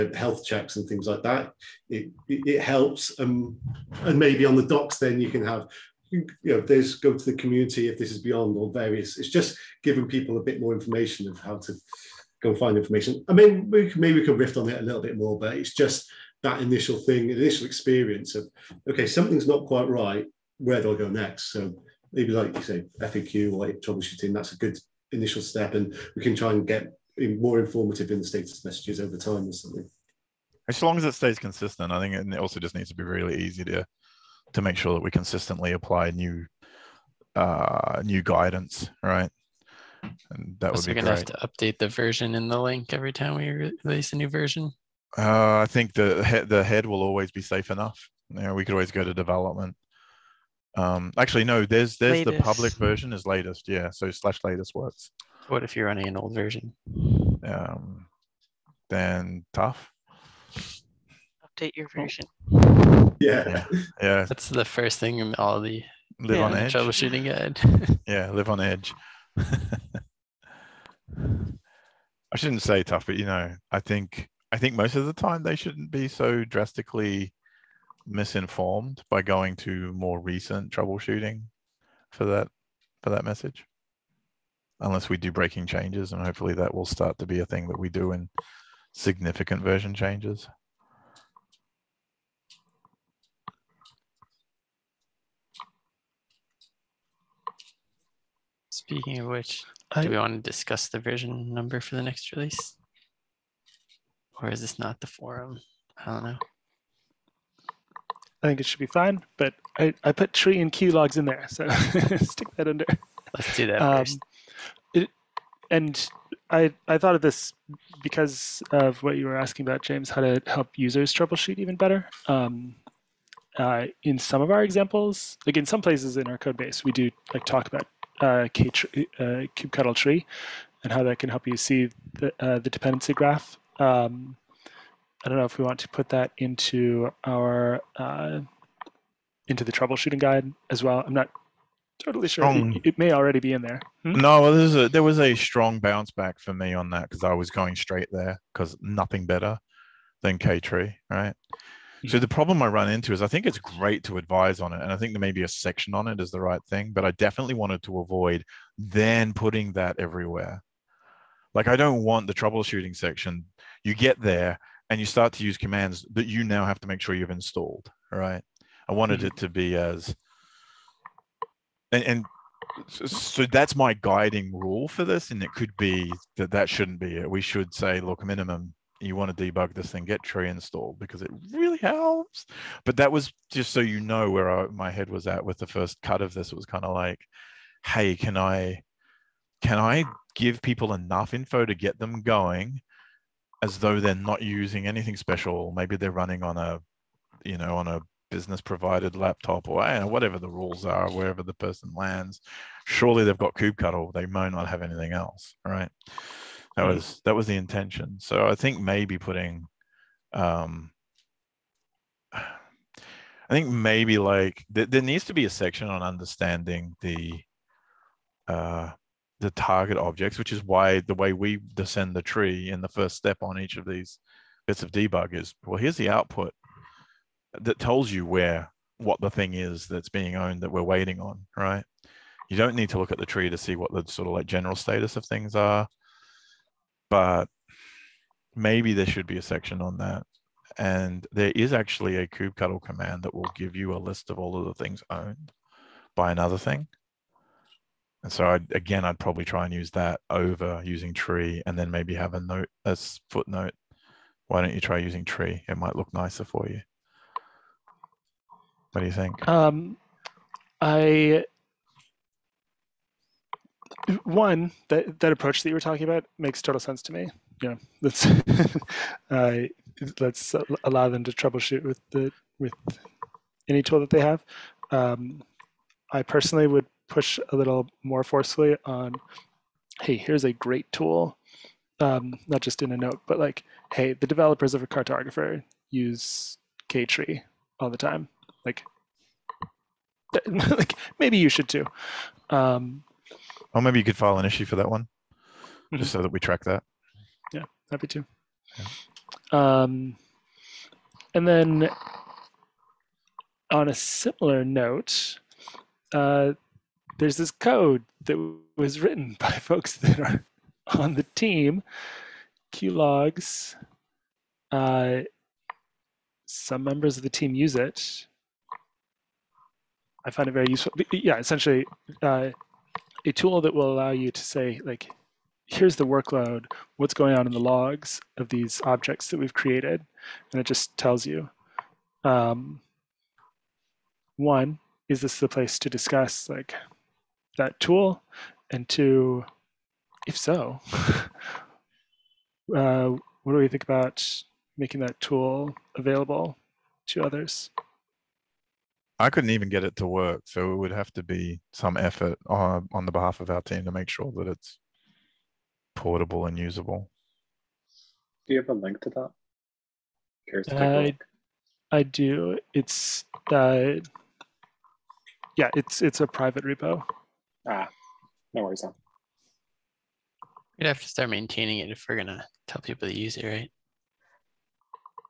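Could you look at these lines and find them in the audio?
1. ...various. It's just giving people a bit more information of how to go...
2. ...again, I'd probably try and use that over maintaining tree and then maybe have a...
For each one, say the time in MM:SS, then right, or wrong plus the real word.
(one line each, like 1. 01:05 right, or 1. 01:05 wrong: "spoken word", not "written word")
1. 00:08 right
2. 04:08 wrong: "using", not "maintaining".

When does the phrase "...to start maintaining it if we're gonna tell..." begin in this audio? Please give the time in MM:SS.
06:11.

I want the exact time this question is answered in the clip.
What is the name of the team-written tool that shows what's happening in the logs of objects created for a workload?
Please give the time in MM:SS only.
05:12.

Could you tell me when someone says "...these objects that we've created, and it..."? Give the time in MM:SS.
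05:28.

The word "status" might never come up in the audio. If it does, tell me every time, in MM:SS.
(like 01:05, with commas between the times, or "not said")
00:28, 03:54.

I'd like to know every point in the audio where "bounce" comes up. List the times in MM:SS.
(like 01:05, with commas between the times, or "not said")
02:25.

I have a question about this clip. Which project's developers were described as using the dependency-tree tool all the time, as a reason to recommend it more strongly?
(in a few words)
Cartographer.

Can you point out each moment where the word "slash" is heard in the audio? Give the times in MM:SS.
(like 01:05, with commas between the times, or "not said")
00:54.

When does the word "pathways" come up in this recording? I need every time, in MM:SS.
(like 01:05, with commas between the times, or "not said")
not said.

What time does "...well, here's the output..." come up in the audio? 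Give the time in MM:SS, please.
03:45.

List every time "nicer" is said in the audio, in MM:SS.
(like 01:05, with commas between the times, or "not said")
04:16.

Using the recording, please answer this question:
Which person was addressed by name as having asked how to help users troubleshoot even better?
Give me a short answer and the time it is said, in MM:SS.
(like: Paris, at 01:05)
James, at 01:59.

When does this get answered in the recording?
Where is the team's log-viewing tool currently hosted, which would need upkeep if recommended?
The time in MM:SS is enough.
06:06.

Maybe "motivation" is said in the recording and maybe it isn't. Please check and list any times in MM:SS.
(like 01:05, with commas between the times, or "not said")
not said.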